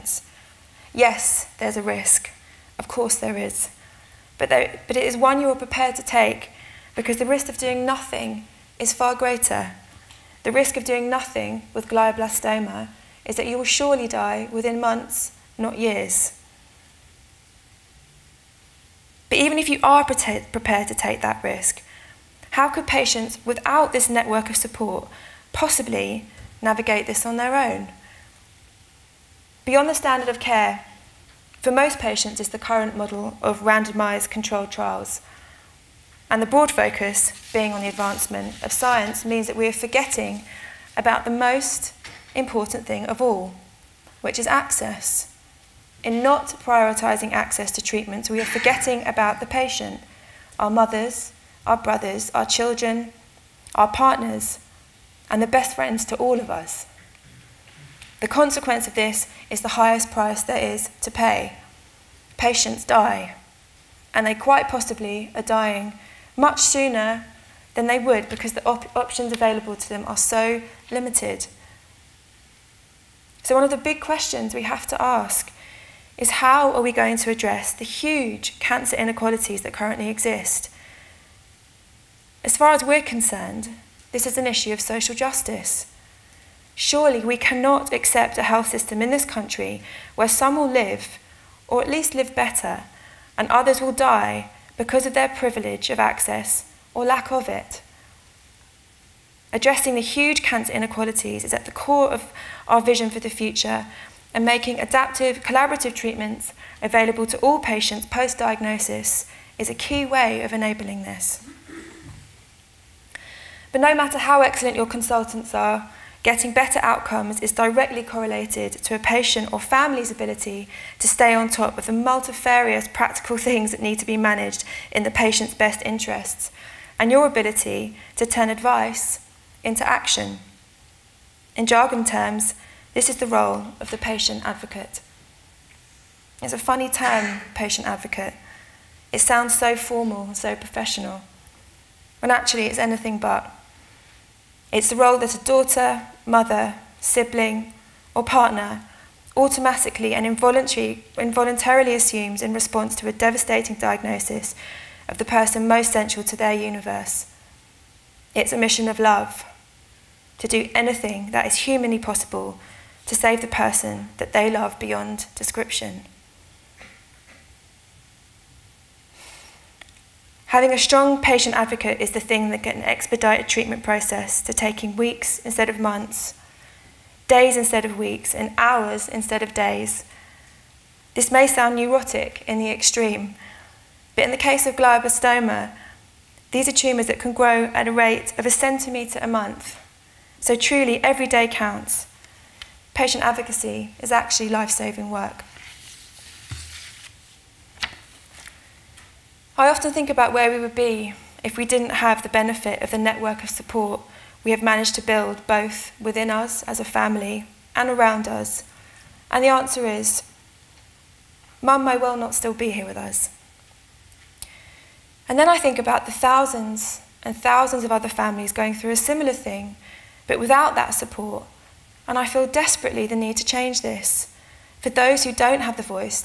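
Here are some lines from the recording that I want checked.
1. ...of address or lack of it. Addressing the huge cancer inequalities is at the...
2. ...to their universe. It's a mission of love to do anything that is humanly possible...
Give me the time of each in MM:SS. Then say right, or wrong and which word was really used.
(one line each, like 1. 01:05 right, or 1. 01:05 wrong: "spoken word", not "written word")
1. 01:35 wrong: "access", not "address"
2. 02:36 right.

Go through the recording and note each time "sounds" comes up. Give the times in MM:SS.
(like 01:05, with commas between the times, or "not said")
02:19, 03:01.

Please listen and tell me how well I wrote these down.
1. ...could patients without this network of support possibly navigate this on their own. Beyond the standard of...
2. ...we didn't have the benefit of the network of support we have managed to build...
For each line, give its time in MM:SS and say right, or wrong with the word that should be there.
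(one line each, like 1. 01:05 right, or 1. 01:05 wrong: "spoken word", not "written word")
1. 00:22 right
2. 03:21 right.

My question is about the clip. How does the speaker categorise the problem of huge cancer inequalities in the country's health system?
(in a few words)
social justice.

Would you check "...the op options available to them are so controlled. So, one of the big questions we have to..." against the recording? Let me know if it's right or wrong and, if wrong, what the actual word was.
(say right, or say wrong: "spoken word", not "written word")
wrong: "limited", not "controlled".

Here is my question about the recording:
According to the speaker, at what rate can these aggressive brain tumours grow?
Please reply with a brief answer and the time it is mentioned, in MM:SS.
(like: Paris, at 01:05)
a centimetre a month, at 03:08.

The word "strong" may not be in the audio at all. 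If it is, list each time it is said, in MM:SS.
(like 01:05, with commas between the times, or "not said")
02:50.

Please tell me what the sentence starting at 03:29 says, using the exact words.
And the answer is Mum may well not still be here with us.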